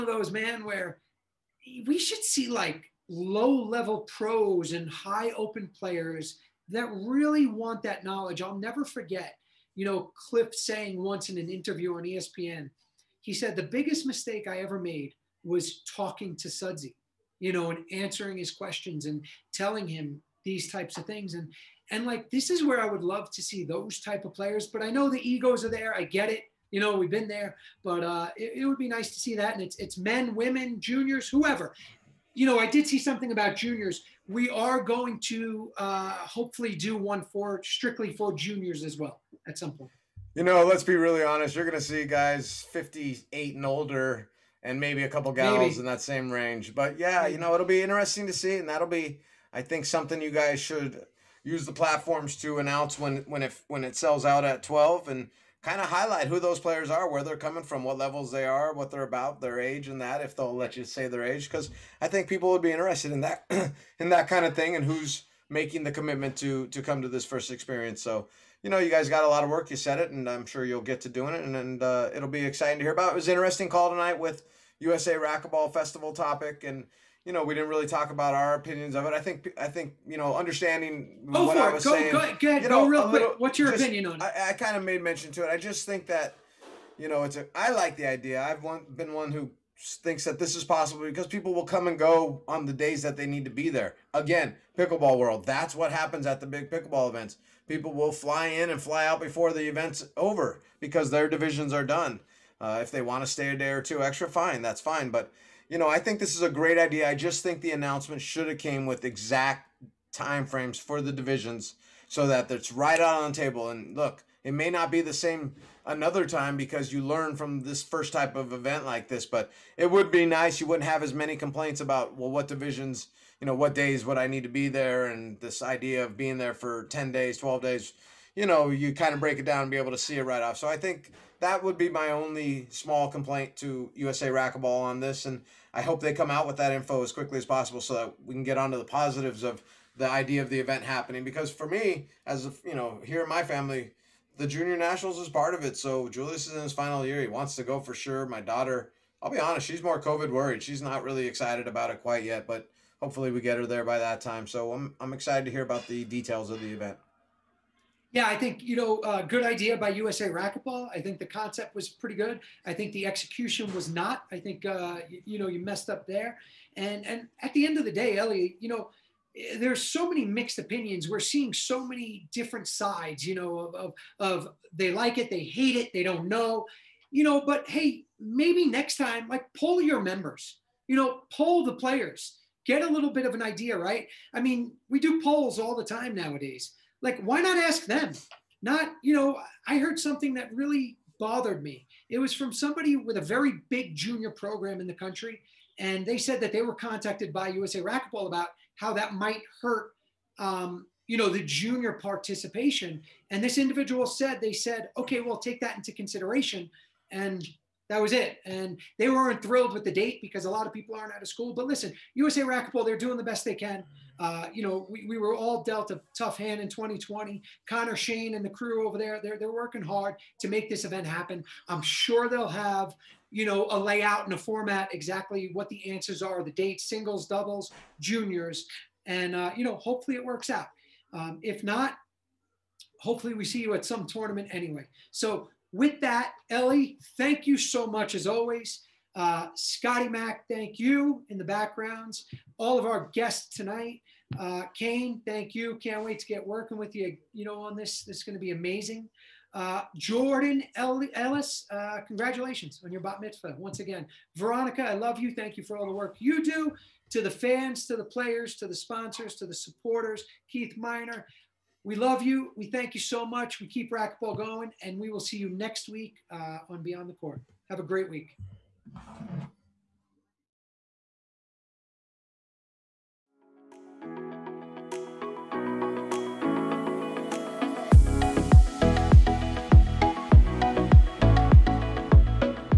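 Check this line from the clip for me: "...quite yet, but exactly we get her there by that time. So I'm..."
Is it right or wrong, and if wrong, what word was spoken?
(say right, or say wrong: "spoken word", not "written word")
wrong: "hopefully", not "exactly".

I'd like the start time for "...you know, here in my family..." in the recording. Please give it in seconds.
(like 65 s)
142 s.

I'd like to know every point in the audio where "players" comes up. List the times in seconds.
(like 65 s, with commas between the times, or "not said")
5 s, 24 s, 56 s, 181 s, 258 s.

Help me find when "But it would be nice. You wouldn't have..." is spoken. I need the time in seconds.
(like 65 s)
119 s.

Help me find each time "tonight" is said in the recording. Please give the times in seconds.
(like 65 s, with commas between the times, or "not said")
73 s, 243 s.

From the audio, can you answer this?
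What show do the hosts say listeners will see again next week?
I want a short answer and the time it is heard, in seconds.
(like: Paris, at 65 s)
Beyond the Court, at 266 s.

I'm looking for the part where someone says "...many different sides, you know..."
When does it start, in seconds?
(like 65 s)
171 s.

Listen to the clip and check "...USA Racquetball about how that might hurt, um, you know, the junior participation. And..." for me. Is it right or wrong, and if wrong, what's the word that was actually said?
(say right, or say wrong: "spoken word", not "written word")
right.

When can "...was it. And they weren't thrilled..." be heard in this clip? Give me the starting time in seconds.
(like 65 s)
208 s.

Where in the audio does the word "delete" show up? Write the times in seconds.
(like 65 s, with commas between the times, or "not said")
not said.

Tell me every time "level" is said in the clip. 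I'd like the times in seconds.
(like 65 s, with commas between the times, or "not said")
3 s, 57 s.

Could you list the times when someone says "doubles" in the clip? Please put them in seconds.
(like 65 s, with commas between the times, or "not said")
227 s.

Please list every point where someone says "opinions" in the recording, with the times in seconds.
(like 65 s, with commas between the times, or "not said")
78 s, 83 s, 170 s.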